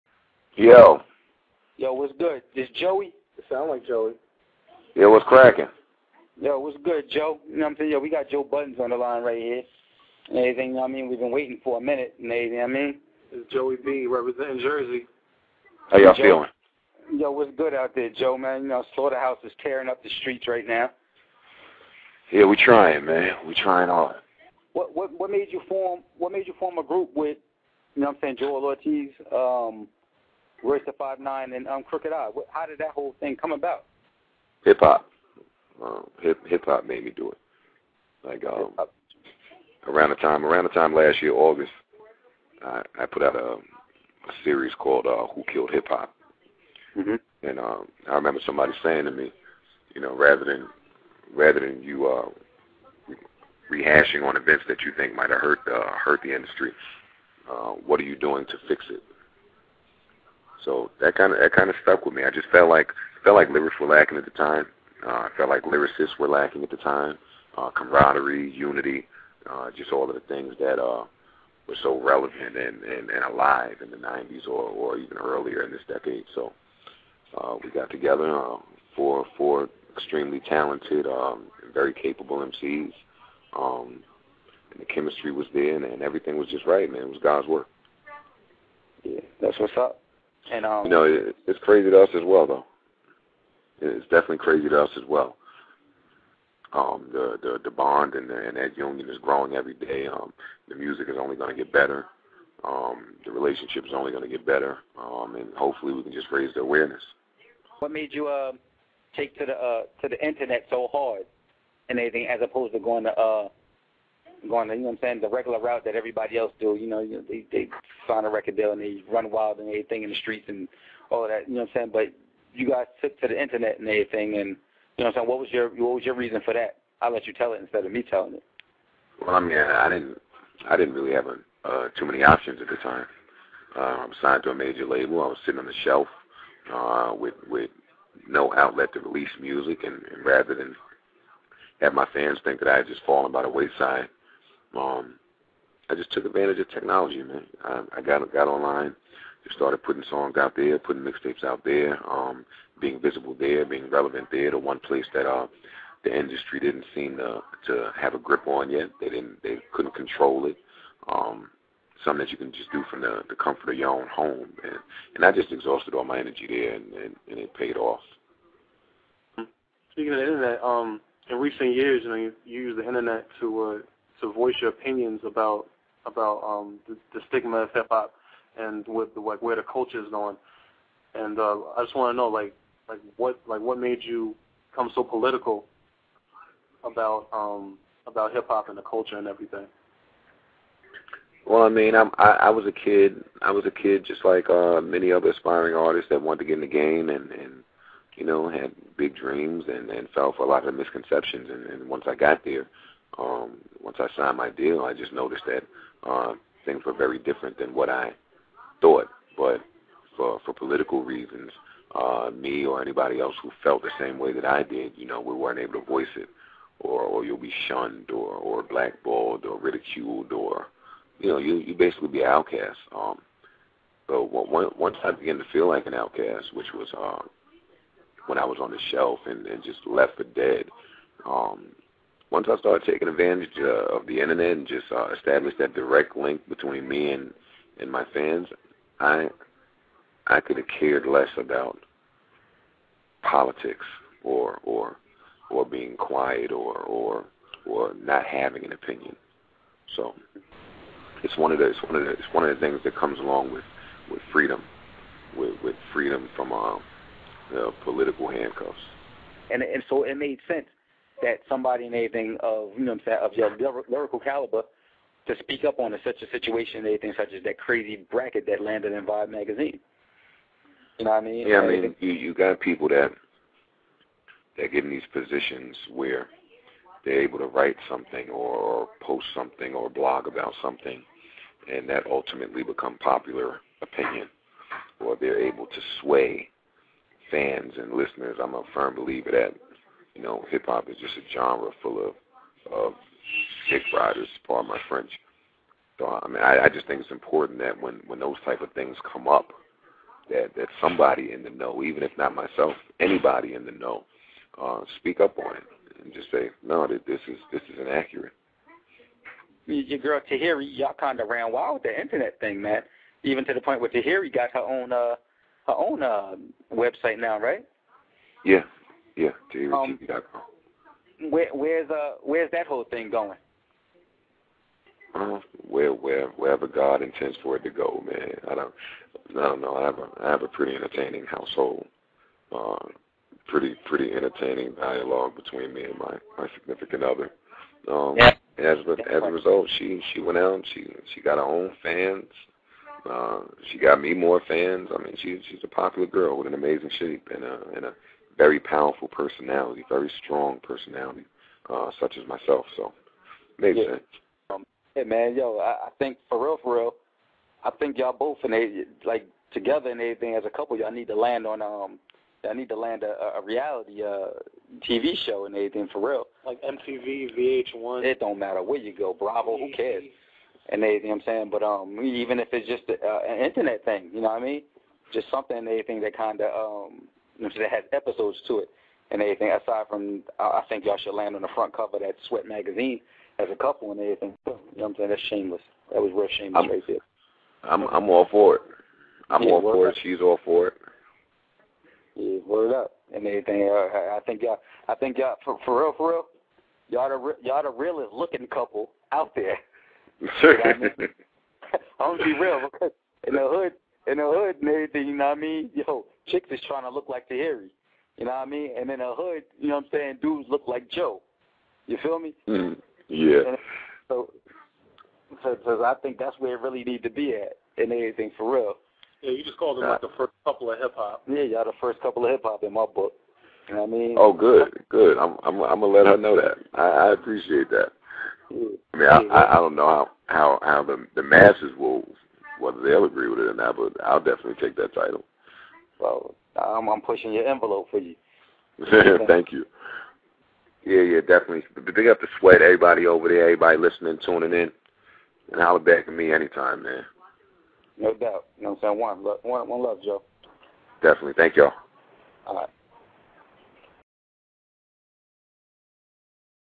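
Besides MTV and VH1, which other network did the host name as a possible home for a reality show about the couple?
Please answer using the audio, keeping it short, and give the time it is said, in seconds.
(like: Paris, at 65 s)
Bravo, at 369 s.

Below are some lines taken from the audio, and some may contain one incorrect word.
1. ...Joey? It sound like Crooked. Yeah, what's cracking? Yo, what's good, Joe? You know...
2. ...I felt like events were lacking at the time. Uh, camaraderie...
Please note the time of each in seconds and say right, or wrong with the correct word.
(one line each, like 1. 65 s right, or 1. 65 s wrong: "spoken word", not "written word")
1. 2 s wrong: "Joey", not "Crooked"
2. 65 s wrong: "lyricists", not "events".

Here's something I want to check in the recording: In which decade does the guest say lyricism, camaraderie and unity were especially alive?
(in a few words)
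the 90s.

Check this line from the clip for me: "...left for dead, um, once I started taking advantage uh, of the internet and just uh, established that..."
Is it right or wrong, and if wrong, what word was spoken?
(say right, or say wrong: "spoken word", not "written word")
right.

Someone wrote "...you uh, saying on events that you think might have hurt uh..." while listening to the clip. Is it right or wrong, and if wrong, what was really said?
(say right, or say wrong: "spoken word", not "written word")
wrong: "rehashing", not "saying".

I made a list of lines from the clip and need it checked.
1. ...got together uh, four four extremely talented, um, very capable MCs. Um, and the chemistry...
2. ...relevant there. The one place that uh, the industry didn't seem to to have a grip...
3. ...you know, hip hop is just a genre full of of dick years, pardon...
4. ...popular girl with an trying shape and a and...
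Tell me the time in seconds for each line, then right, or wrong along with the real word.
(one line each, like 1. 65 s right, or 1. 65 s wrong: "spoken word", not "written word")
1. 77 s right
2. 153 s right
3. 290 s wrong: "riders", not "years"
4. 345 s wrong: "amazing", not "trying".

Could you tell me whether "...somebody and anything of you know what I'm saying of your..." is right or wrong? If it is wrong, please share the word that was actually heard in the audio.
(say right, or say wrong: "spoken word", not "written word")
right.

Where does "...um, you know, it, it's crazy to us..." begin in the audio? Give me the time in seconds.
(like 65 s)
90 s.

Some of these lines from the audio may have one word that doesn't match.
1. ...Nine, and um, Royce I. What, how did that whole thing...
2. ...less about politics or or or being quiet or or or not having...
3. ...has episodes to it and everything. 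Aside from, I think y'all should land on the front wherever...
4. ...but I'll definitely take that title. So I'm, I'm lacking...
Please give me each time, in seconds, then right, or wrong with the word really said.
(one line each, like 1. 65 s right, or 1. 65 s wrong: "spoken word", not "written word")
1. 31 s wrong: "Crooked", not "Royce"
2. 241 s right
3. 377 s wrong: "cover", not "wherever"
4. 433 s wrong: "pushing", not "lacking".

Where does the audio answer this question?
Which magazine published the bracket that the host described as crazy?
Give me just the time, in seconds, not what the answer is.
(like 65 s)
269 s.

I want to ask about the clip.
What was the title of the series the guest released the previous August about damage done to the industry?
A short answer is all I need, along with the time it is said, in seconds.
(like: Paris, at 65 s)
Who Killed Hip Hop, at 45 s.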